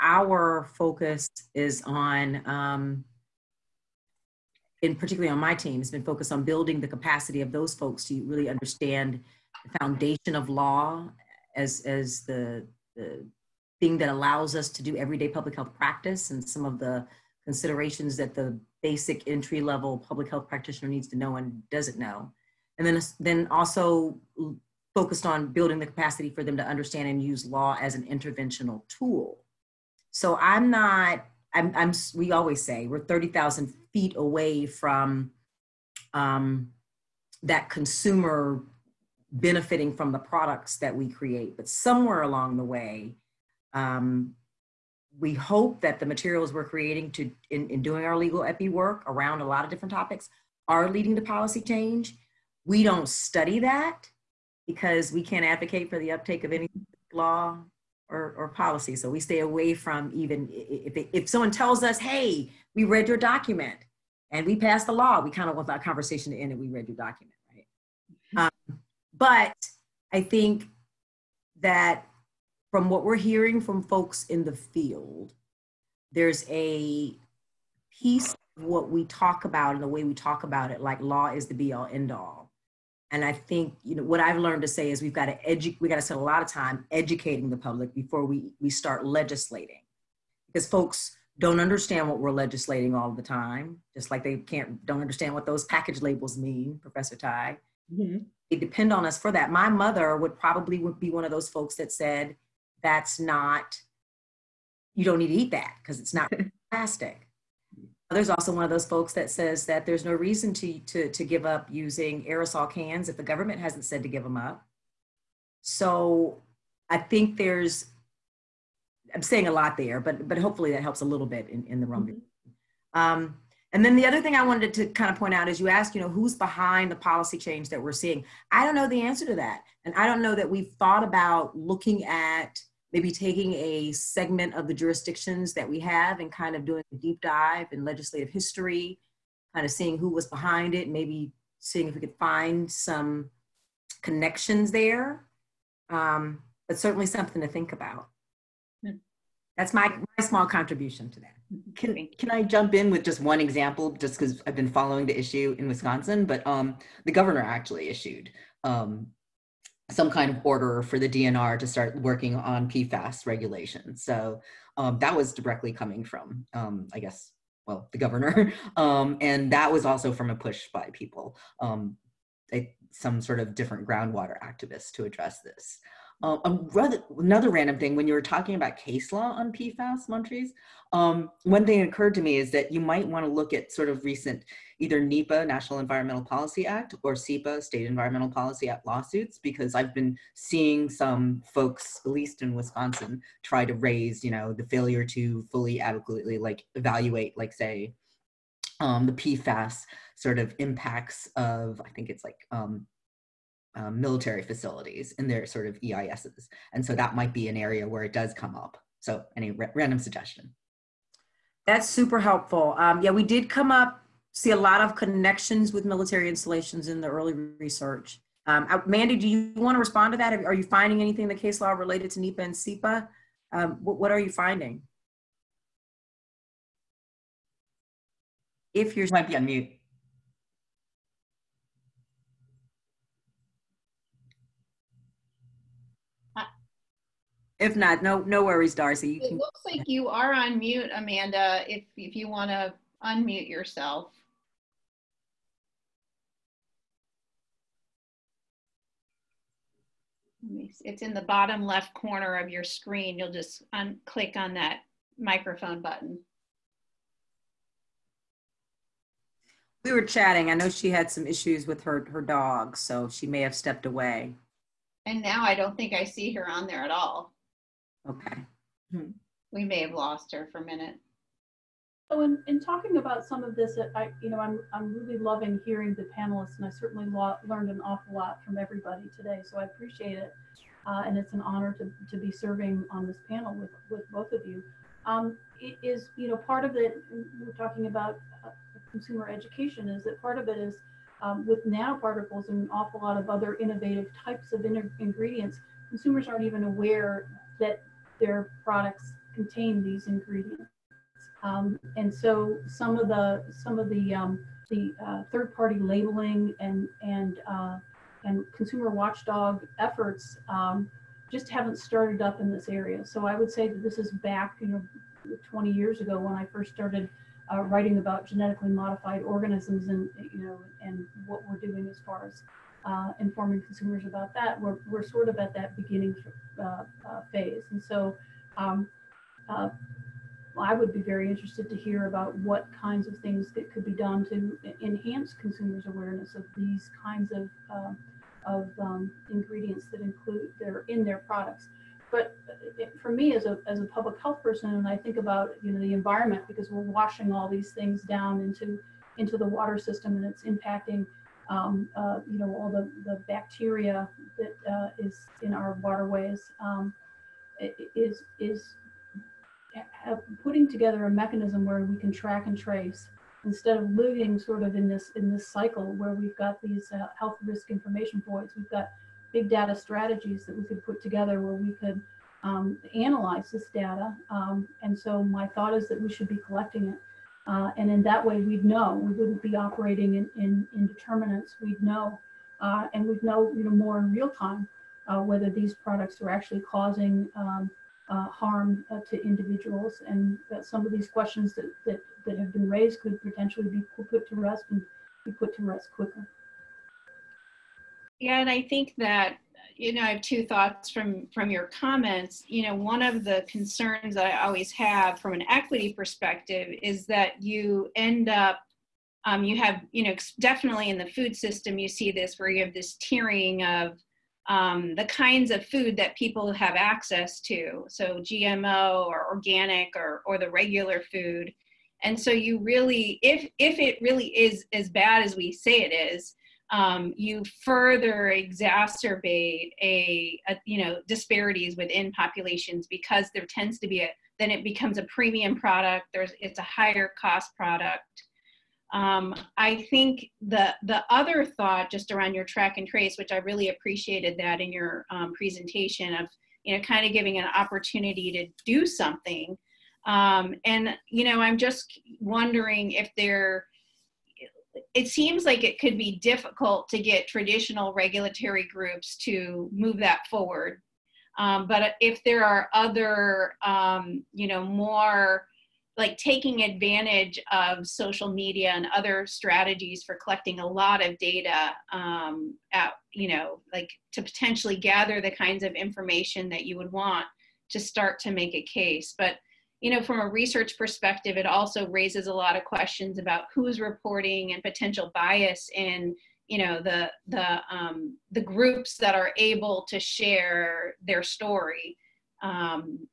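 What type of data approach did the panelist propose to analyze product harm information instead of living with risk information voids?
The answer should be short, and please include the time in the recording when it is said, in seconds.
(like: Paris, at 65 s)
big data strategies, at 369 s.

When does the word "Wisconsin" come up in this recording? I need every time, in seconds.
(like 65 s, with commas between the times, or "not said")
155 s, 192 s.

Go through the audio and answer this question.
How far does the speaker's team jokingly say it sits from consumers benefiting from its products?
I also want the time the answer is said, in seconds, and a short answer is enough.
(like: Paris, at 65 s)
30,000 feet, at 33 s.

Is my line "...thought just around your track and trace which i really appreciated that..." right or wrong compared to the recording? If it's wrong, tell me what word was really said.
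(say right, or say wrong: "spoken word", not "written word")
right.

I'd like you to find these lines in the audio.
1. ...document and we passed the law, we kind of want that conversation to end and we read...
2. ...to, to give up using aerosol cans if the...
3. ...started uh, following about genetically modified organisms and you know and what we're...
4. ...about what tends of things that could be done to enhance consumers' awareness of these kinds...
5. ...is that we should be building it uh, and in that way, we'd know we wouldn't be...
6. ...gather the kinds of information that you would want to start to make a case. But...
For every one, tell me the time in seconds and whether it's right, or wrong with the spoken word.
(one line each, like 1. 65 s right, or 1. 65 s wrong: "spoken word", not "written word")
1. 63 s right
2. 110 s right
3. 316 s wrong: "writing", not "following"
4. 332 s wrong: "kinds", not "tends"
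5. 375 s wrong: "collecting", not "building"
6. 474 s right.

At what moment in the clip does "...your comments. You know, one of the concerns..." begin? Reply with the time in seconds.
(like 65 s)
401 s.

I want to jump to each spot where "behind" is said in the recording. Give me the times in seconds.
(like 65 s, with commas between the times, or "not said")
126 s, 140 s.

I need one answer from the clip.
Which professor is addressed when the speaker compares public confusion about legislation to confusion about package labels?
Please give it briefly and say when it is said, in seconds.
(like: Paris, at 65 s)
Professor Tai, at 96 s.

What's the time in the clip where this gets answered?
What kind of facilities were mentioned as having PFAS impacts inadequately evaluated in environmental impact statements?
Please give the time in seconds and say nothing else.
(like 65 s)
204 s.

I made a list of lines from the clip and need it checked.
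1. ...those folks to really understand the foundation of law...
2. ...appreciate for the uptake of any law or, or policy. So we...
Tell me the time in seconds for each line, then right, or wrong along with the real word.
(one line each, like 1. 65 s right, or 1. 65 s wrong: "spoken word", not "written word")
1. 7 s right
2. 55 s wrong: "advocate", not "appreciate".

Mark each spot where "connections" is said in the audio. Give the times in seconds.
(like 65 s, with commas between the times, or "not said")
144 s, 214 s.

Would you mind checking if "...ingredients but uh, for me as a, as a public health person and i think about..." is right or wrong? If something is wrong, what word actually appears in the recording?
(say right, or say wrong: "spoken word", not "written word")
wrong: "products", not "ingredients".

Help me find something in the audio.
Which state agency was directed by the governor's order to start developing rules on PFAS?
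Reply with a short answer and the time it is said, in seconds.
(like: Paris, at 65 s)
DNR, at 161 s.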